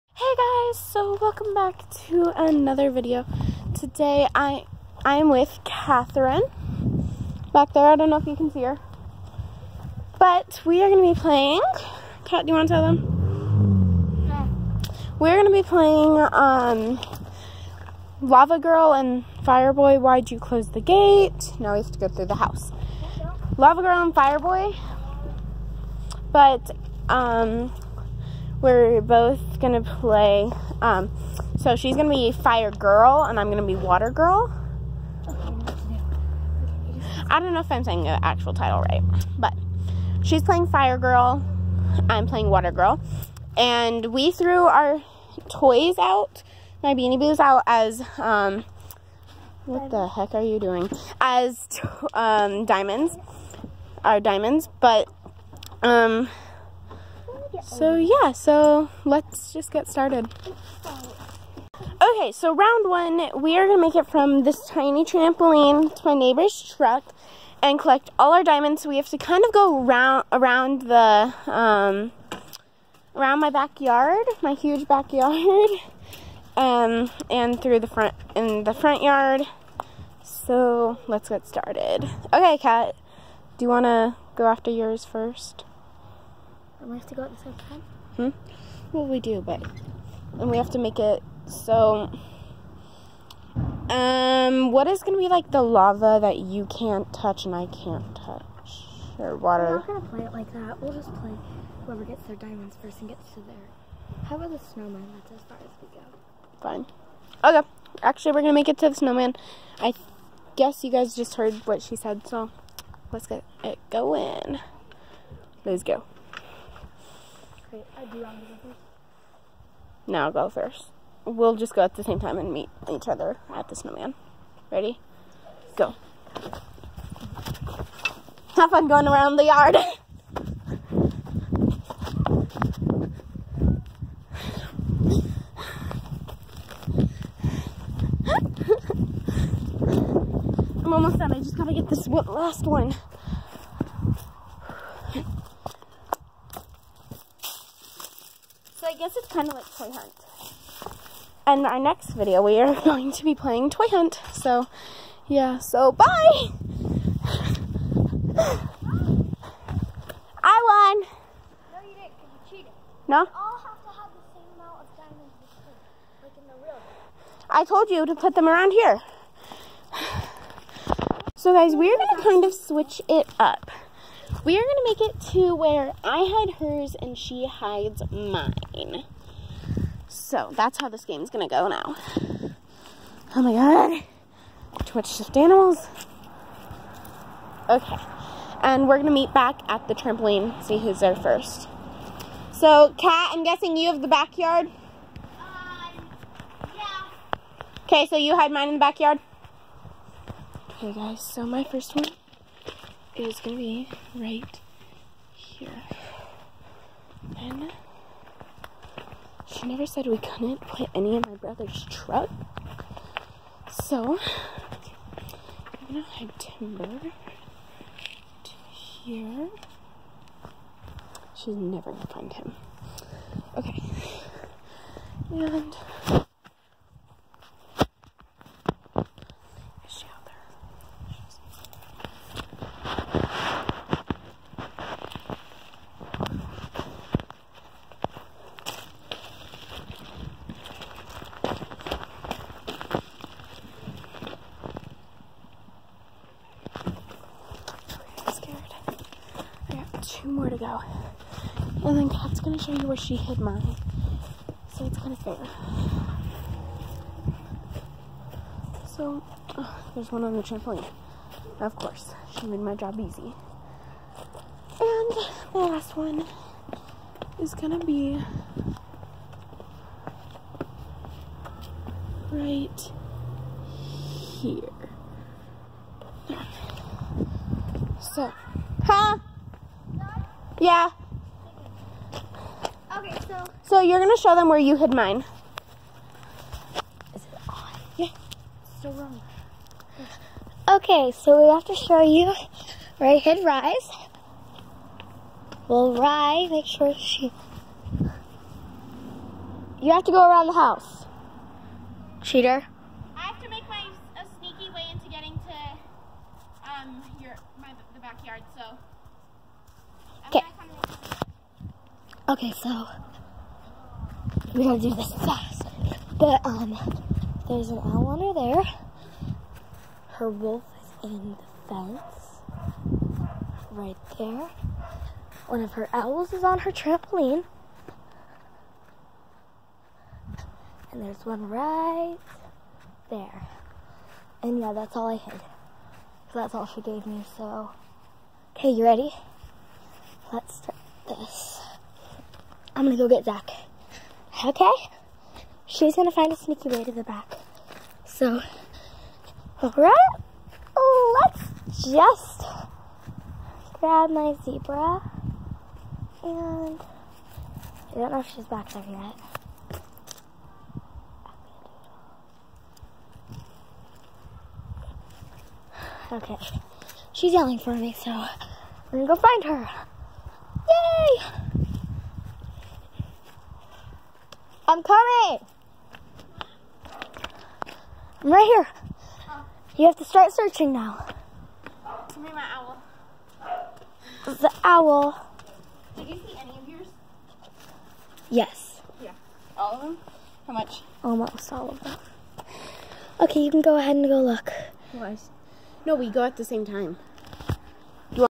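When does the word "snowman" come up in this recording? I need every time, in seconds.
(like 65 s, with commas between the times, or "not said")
104 s, 108 s, 123 s.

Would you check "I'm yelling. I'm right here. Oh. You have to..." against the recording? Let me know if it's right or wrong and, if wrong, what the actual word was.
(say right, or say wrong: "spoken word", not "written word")
wrong: "coming", not "yelling".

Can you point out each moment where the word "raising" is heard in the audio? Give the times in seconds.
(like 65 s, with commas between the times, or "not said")
not said.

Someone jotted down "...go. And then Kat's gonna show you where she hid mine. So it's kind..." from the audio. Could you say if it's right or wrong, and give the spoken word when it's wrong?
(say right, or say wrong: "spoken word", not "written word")
right.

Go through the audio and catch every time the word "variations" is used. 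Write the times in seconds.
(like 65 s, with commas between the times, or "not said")
not said.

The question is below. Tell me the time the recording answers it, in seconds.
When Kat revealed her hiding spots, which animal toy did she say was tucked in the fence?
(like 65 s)
320 s.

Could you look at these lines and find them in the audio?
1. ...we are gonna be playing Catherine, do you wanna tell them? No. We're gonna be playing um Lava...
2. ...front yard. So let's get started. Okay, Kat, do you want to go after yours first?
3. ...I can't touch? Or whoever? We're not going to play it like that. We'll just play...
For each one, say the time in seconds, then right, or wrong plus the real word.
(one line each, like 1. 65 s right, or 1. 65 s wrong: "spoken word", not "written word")
1. 10 s wrong: "Kat", not "Catherine"
2. 78 s right
3. 97 s wrong: "water", not "whoever".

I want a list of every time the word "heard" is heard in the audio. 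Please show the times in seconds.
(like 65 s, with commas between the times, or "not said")
111 s.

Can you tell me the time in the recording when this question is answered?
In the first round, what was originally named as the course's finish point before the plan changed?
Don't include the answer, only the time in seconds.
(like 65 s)
66 s.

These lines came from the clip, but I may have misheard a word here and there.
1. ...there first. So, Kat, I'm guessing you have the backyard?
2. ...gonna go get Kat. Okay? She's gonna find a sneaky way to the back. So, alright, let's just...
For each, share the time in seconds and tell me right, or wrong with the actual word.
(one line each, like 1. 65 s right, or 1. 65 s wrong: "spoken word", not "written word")
1. 190 s right
2. 342 s wrong: "Zach", not "Kat".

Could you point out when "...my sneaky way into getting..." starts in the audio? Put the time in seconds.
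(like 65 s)
303 s.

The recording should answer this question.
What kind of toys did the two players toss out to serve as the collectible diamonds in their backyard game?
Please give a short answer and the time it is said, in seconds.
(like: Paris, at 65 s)
Beanie Boos, at 46 s.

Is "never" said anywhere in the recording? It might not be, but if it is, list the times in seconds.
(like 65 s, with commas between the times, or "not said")
209 s, 221 s.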